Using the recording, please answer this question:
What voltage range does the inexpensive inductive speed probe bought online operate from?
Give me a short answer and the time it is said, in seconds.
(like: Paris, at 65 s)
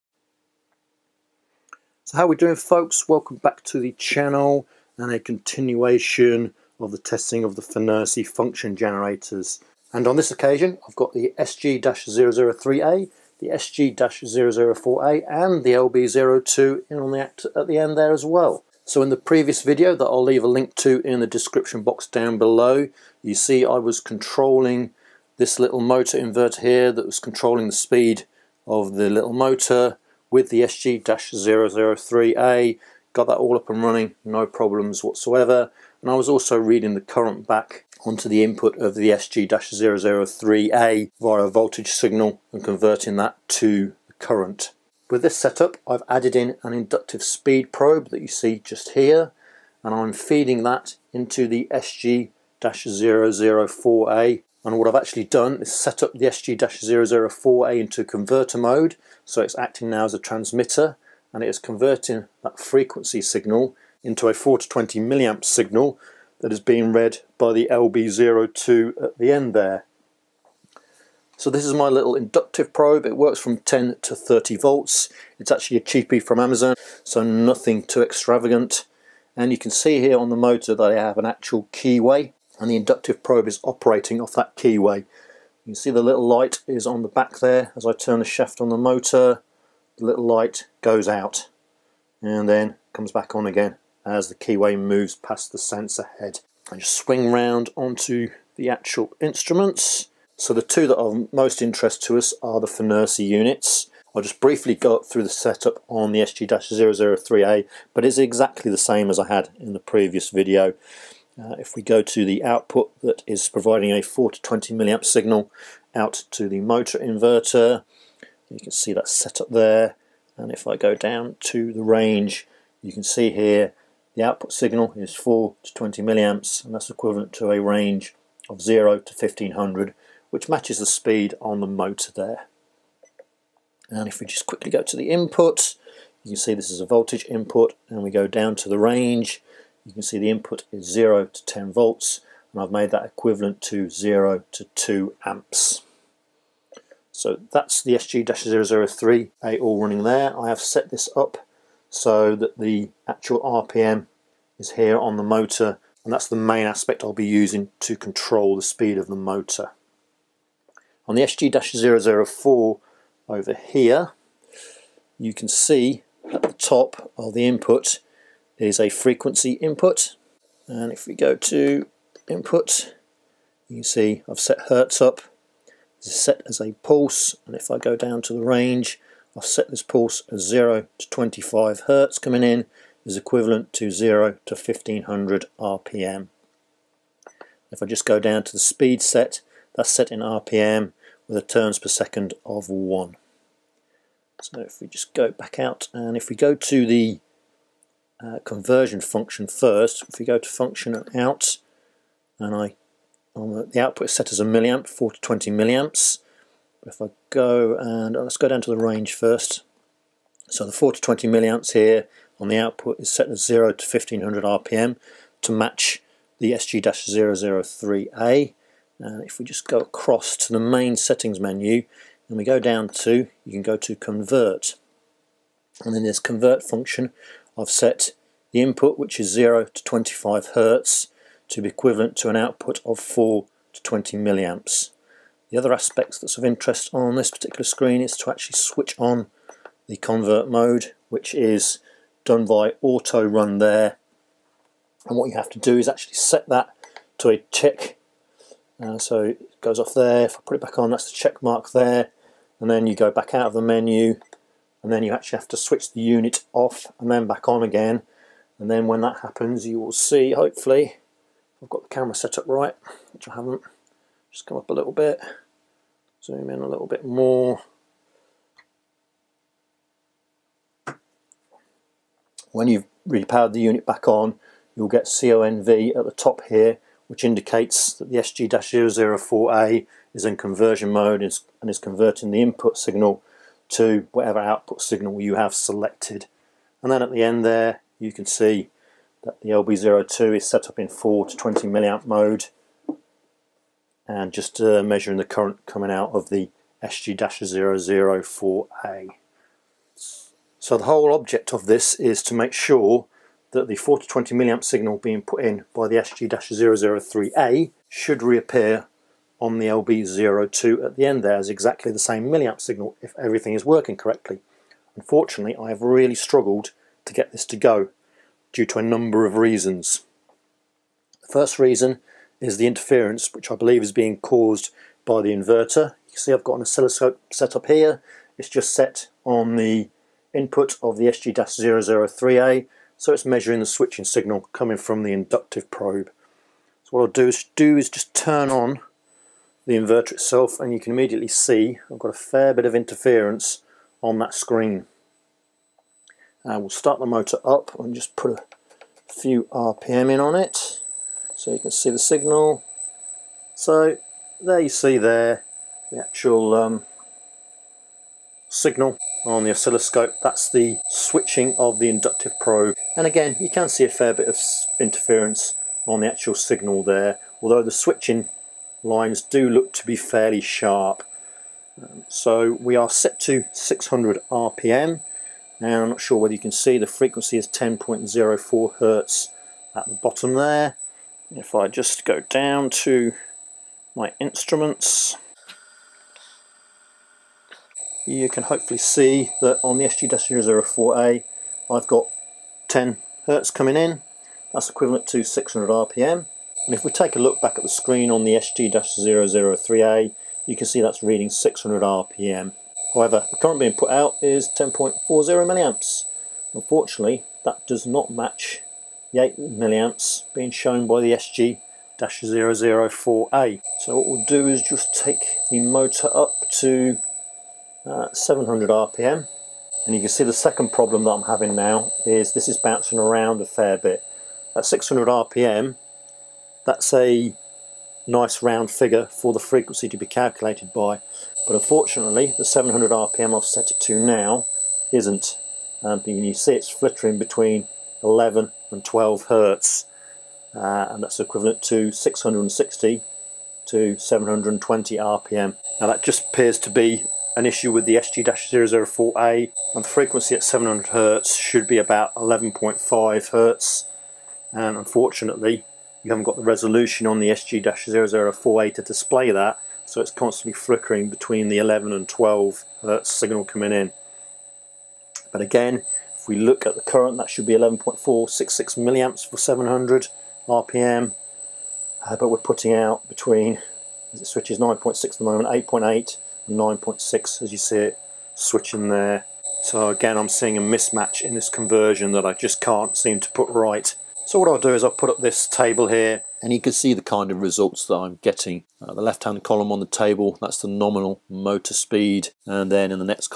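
10 to 30 volts, at 73 s.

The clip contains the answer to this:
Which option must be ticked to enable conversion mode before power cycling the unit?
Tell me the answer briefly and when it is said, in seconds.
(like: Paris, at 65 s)
auto run, at 242 s.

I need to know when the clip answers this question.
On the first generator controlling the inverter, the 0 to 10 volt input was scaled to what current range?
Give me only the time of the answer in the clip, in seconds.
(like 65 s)
143 s.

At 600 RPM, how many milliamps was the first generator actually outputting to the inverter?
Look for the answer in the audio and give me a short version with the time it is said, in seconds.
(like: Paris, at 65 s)
10.40 milliamps, at 404 s.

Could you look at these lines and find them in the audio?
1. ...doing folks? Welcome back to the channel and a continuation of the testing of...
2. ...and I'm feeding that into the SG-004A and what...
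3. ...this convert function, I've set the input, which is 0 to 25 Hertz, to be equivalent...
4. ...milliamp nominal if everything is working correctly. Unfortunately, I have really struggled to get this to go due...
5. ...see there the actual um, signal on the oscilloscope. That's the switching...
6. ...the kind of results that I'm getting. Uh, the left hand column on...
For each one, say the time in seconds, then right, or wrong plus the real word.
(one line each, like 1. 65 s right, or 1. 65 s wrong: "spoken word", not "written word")
1. 2 s right
2. 49 s right
3. 226 s right
4. 312 s wrong: "signal", not "nominal"
5. 354 s right
6. 486 s right.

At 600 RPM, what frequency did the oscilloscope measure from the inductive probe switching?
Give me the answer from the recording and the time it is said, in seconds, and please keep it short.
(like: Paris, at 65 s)
10.04 Hertz, at 377 s.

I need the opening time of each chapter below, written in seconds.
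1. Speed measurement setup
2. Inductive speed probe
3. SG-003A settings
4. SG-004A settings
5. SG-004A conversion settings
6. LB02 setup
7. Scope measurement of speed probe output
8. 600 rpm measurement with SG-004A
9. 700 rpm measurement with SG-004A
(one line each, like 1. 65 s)
1. 39 s
2. 70 s
3. 95 s
4. 159 s
5. 217 s
6. 285 s
7. 299 s
8. 386 s
9. 412 s.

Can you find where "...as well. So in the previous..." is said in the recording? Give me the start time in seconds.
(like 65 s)
18 s.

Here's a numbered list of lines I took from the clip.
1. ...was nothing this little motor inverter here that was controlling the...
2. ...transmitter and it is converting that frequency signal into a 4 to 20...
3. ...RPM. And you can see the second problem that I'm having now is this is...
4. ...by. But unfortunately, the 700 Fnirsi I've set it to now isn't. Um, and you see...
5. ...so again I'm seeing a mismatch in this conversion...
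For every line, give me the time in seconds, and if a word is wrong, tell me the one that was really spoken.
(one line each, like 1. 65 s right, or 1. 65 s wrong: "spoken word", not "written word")
1. 23 s wrong: "controlling", not "nothing"
2. 60 s right
3. 418 s right
4. 430 s wrong: "RPM", not "Fnirsi"
5. 479 s right.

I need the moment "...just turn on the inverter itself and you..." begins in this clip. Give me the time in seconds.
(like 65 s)
337 s.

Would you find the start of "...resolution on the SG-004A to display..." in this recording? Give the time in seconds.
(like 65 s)
456 s.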